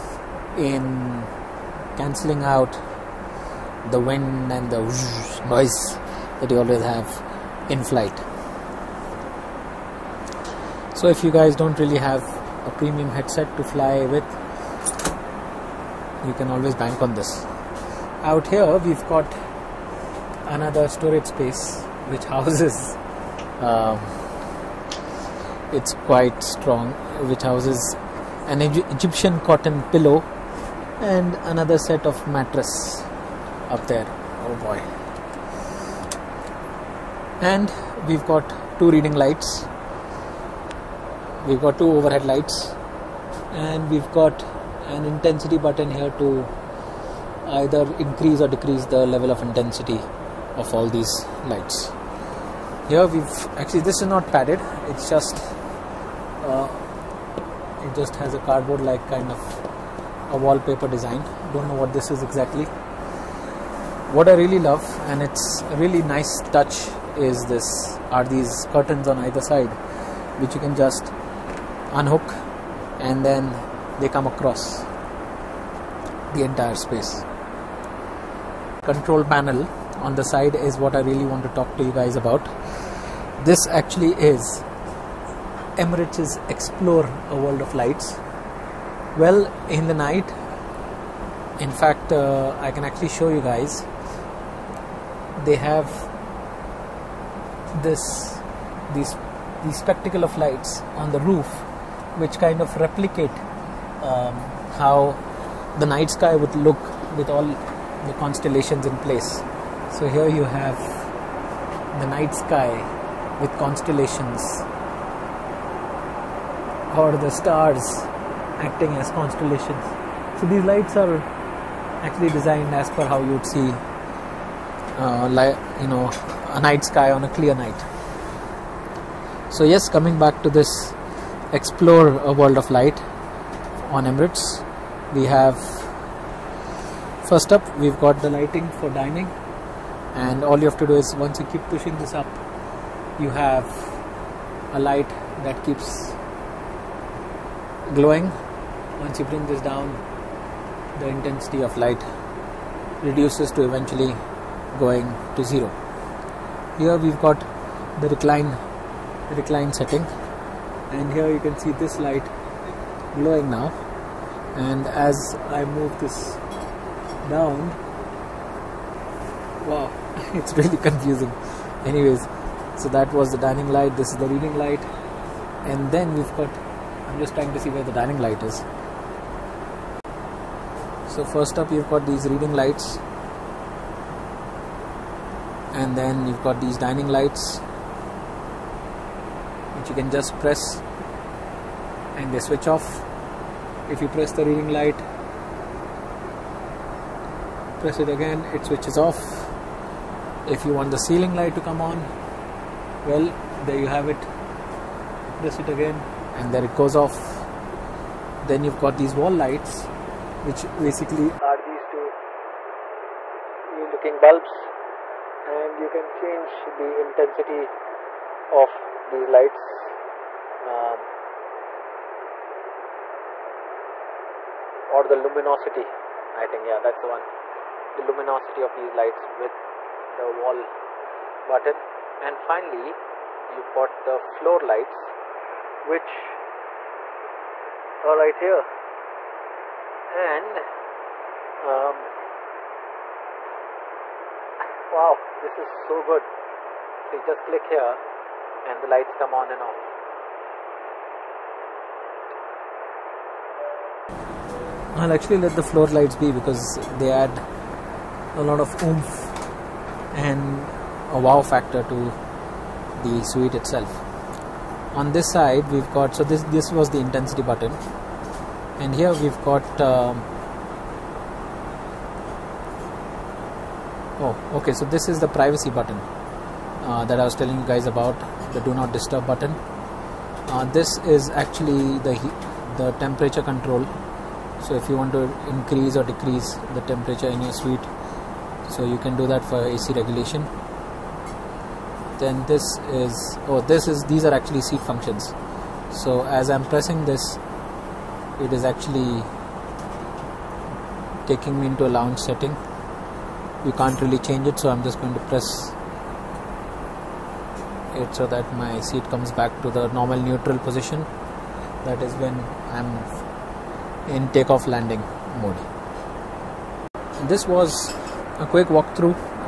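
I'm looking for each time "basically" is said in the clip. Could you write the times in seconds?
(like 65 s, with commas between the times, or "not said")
210 s.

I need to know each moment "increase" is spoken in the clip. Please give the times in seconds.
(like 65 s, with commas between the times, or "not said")
47 s, 285 s.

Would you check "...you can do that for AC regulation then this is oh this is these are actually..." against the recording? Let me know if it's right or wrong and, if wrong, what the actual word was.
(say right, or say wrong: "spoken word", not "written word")
right.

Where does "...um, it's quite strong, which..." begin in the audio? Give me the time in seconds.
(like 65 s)
23 s.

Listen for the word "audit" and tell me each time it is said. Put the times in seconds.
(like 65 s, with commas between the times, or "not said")
not said.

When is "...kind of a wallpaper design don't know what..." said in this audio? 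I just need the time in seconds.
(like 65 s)
59 s.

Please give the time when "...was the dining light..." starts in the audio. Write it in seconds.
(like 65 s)
173 s.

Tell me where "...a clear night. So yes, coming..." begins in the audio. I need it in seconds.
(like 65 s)
127 s.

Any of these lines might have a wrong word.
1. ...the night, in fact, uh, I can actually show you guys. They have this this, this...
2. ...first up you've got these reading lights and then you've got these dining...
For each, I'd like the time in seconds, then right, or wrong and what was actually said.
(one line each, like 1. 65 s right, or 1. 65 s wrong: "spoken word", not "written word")
1. 89 s right
2. 181 s right.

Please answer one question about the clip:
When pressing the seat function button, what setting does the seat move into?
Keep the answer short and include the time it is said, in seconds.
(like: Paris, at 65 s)
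Lounge setting, at 301 s.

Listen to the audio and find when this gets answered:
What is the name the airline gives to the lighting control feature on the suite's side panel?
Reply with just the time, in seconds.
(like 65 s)
86 s.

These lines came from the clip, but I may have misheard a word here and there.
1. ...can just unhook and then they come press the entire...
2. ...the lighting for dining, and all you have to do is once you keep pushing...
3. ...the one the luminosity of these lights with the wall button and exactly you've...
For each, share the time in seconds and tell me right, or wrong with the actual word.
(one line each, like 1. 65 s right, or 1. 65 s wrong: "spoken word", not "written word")
1. 70 s wrong: "across", not "press"
2. 138 s right
3. 227 s wrong: "finally", not "exactly".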